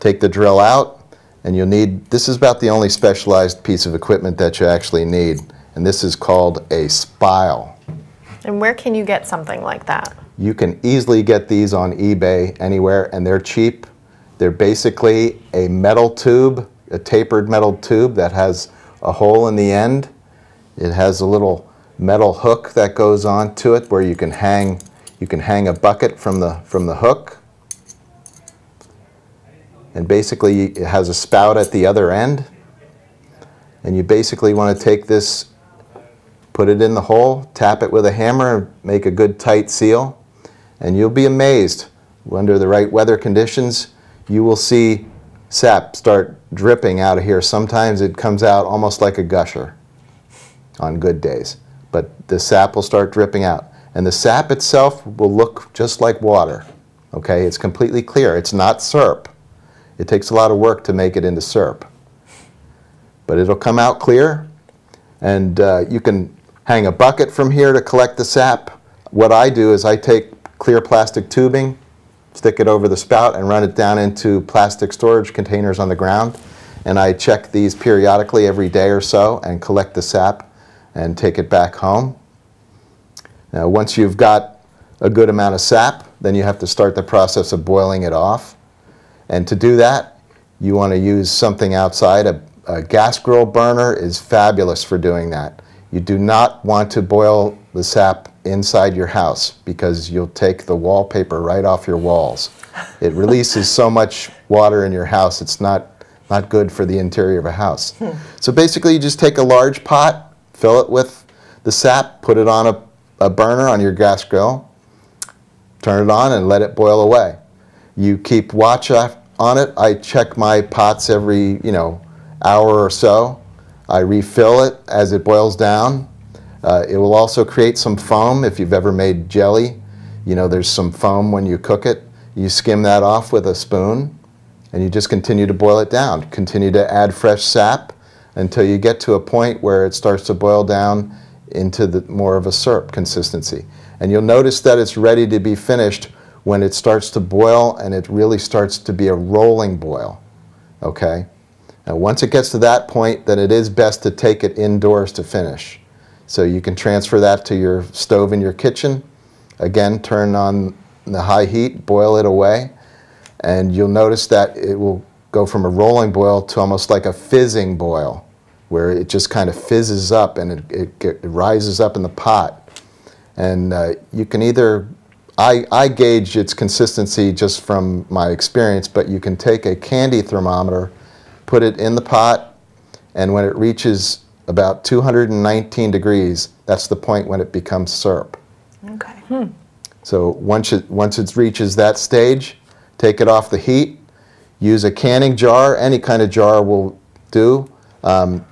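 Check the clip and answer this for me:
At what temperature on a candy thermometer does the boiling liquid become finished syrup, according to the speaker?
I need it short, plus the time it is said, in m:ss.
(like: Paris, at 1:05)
219 degrees, at 3:04.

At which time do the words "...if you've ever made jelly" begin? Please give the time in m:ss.
2:08.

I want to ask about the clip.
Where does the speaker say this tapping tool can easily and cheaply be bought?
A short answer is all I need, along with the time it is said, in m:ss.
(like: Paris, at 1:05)
eBay, at 0:11.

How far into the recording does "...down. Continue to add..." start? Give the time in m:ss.
2:15.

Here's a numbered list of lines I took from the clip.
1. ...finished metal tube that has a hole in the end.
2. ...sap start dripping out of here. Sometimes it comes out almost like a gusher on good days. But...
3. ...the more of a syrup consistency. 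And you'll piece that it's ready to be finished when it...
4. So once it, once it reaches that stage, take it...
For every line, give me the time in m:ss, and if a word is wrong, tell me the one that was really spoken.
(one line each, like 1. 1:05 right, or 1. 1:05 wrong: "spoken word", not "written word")
1. 0:16 wrong: "tapered", not "finished"
2. 0:45 right
3. 2:21 wrong: "notice", not "piece"
4. 3:10 right.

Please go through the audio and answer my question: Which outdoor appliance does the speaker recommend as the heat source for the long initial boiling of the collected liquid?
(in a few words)
gas grill burner.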